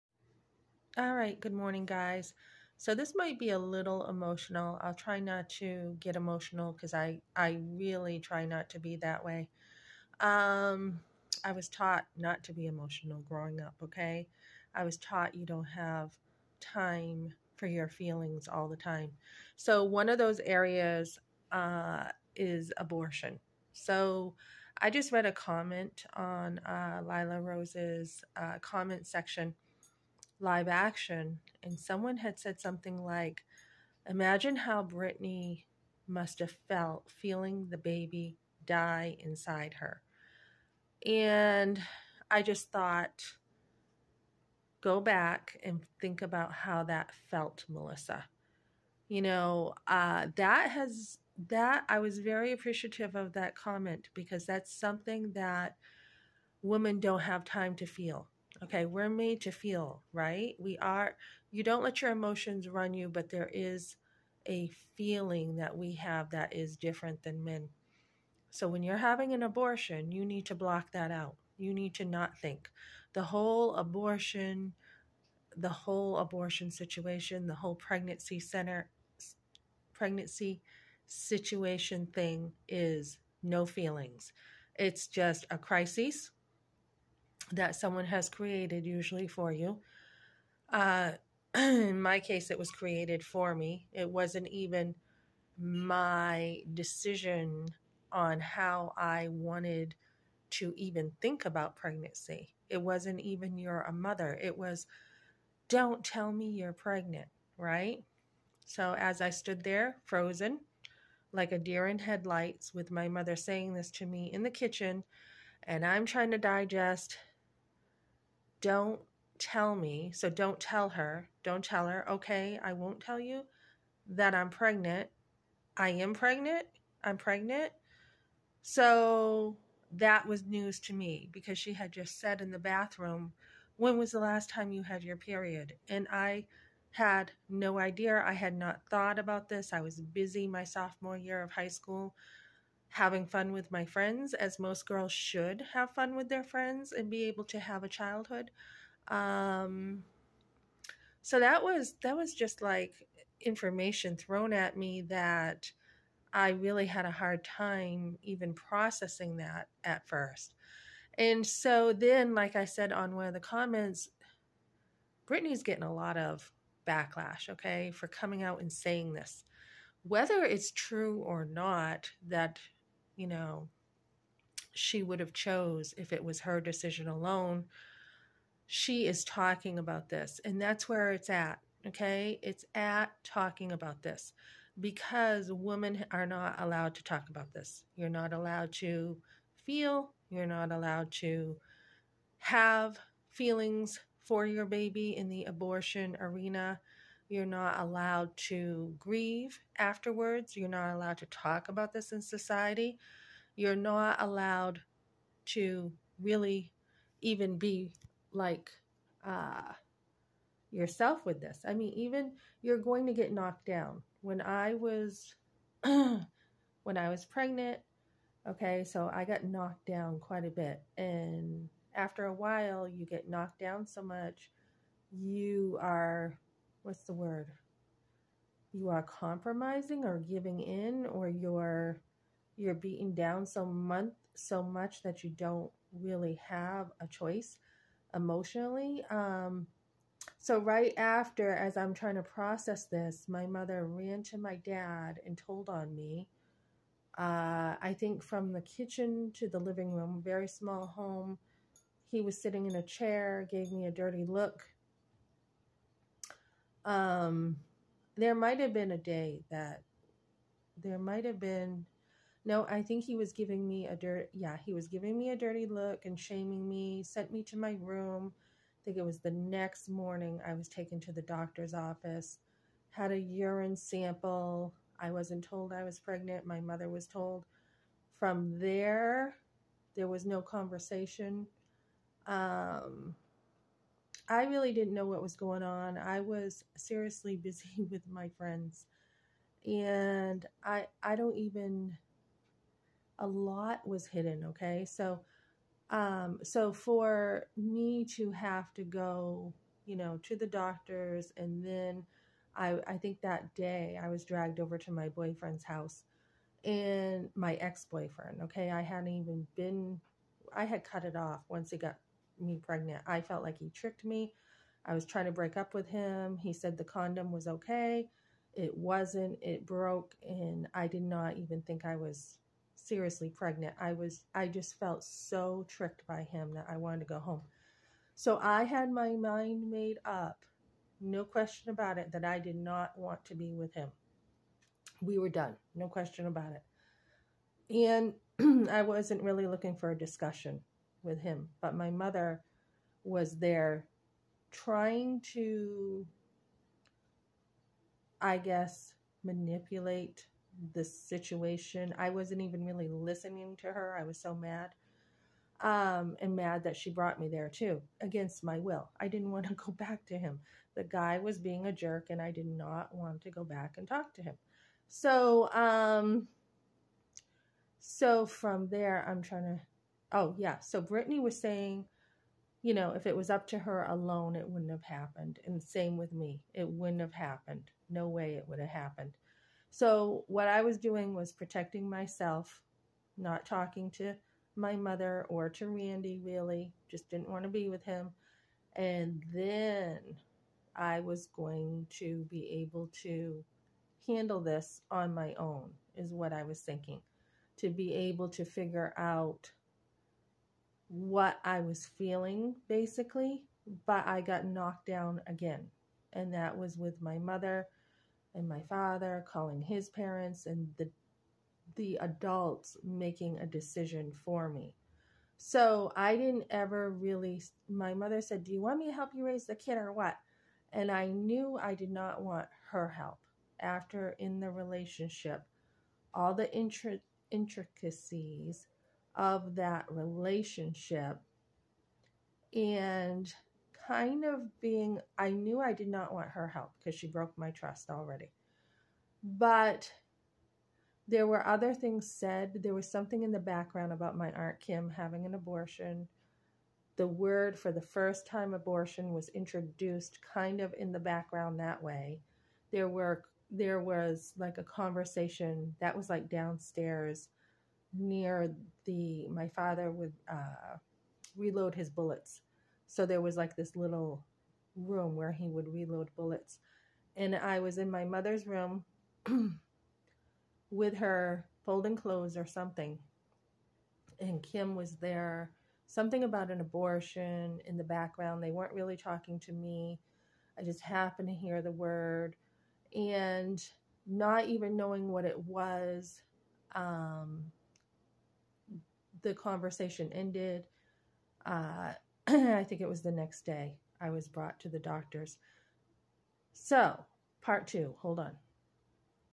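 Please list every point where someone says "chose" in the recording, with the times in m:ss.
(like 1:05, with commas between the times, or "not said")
2:55.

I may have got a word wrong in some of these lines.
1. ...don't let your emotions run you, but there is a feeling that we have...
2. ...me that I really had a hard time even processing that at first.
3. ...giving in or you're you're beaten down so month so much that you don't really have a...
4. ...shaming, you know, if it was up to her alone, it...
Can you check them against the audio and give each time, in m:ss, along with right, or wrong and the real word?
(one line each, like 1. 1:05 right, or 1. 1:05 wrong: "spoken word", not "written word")
1. 1:01 right
2. 2:34 right
3. 3:50 right
4. 6:11 wrong: "saying", not "shaming".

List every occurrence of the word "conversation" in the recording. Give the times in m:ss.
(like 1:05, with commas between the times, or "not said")
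4:40, 7:34, 8:09.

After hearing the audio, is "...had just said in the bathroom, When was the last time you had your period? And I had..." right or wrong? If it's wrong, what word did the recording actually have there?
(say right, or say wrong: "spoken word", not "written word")
right.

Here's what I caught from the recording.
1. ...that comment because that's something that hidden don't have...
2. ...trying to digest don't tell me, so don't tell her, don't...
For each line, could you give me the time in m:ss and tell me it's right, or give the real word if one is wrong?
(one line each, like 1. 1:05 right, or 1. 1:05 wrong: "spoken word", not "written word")
1. 0:53 wrong: "women", not "hidden"
2. 1:56 right.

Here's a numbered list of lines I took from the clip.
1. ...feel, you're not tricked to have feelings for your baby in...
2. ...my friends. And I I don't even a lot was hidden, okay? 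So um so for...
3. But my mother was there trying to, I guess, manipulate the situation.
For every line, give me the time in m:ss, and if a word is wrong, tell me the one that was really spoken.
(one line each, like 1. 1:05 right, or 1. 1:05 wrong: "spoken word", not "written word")
1. 3:09 wrong: "allowed", not "tricked"
2. 4:48 right
3. 5:41 right.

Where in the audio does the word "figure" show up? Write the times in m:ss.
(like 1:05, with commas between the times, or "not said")
6:38.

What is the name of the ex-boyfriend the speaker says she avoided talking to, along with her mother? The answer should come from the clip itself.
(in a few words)
Randy.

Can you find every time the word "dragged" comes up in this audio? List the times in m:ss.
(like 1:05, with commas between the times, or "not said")
5:04.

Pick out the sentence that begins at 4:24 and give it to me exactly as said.
Yeah, he was giving me a dirty look and shaming me.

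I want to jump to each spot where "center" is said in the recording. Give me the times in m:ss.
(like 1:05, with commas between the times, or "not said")
1:18.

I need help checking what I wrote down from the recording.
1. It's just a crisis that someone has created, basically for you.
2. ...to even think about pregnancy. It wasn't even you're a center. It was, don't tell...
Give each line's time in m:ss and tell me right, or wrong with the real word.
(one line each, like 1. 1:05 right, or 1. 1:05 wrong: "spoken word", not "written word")
1. 1:24 wrong: "usually", not "basically"
2. 1:40 wrong: "mother", not "center".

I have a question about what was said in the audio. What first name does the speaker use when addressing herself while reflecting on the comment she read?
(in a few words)
Melissa.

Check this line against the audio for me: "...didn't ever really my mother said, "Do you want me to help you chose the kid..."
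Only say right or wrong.
wrong.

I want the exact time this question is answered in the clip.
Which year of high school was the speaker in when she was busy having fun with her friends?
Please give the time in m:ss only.
2:20.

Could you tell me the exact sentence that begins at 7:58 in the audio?
They weren't really talking to me.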